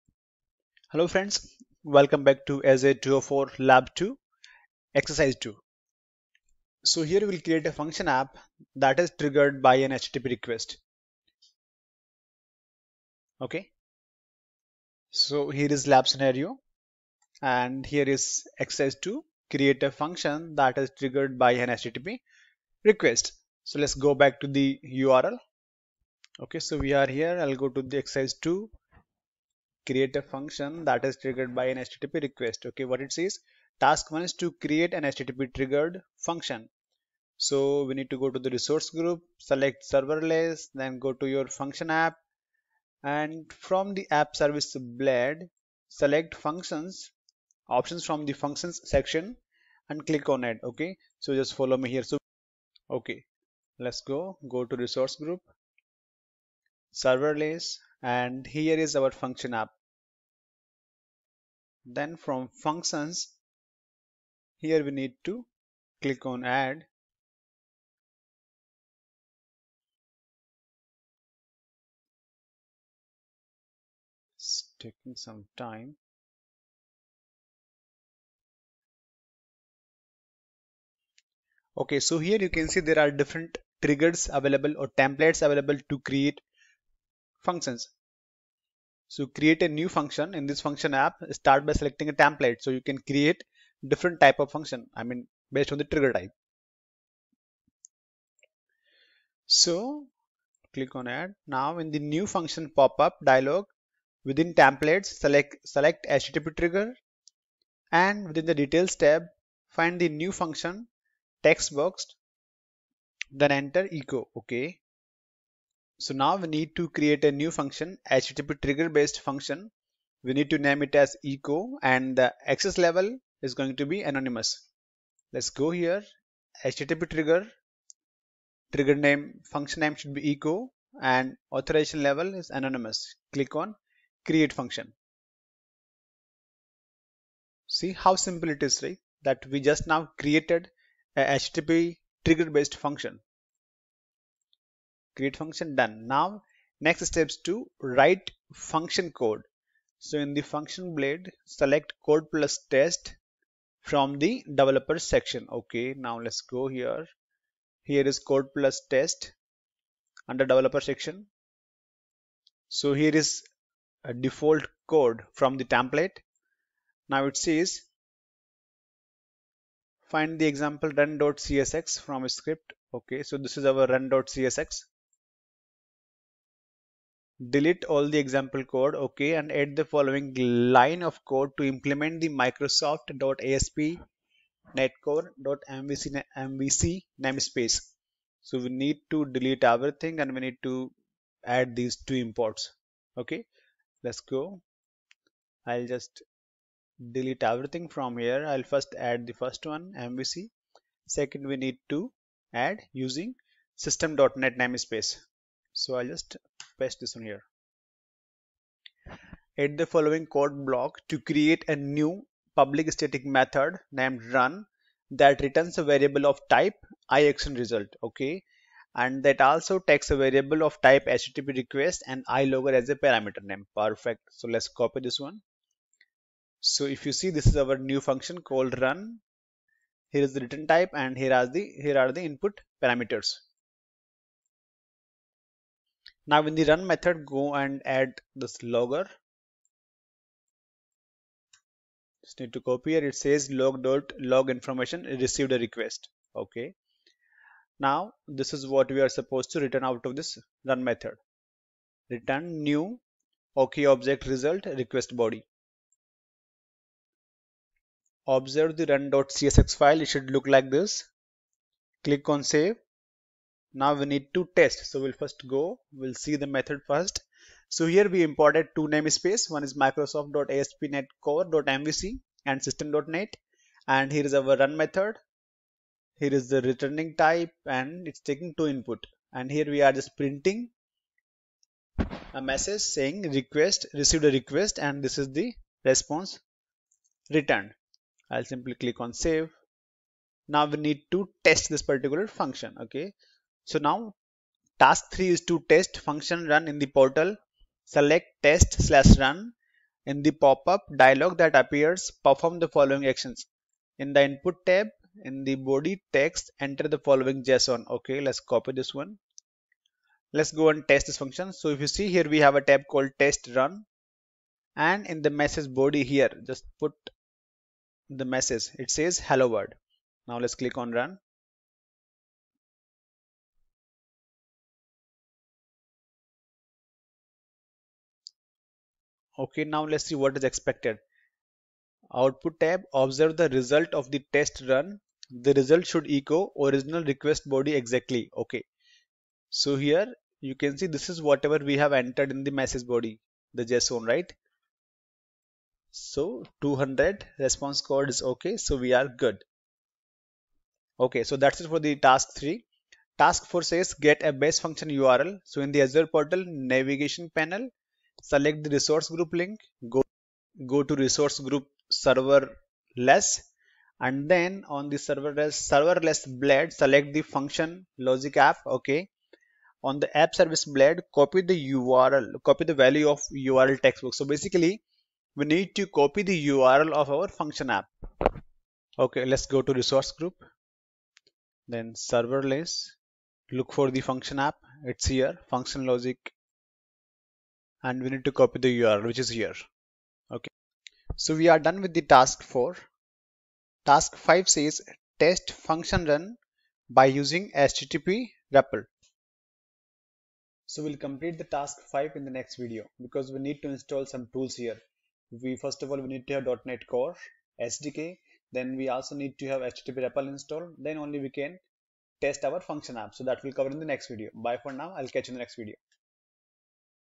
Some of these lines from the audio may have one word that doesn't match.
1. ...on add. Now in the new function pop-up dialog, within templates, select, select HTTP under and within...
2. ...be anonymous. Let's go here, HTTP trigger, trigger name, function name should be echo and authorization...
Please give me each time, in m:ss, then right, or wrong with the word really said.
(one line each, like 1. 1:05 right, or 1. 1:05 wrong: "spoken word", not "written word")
1. 1:40 wrong: "trigger", not "under"
2. 2:03 right.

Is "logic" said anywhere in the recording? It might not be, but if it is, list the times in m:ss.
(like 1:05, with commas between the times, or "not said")
6:07, 6:25.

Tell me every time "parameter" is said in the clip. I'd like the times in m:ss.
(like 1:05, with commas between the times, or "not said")
3:43, 3:52.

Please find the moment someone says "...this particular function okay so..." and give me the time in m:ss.
4:51.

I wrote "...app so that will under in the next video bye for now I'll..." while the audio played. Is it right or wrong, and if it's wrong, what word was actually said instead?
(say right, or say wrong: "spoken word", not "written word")
wrong: "cover", not "under".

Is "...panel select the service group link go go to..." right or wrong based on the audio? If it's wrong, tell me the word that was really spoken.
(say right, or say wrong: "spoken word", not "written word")
wrong: "resource", not "service".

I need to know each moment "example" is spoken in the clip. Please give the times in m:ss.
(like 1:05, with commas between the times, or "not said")
2:50, 2:58.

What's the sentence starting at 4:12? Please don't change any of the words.
Return new OK object result request body.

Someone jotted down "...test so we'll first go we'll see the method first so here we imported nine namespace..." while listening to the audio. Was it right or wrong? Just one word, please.
wrong.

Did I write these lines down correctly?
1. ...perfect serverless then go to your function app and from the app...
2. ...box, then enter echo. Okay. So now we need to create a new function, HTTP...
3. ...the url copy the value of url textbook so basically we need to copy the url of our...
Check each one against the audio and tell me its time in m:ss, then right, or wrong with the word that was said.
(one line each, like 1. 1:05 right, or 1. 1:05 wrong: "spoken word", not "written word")
1. 0:39 wrong: "select", not "perfect"
2. 1:51 right
3. 6:11 right.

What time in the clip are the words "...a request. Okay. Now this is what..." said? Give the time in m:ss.
4:05.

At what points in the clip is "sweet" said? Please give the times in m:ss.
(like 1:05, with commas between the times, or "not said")
not said.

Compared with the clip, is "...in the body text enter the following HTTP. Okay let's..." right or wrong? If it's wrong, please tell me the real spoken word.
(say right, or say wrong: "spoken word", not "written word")
wrong: "JSON", not "HTTP".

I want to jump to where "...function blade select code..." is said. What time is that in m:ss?
2:30.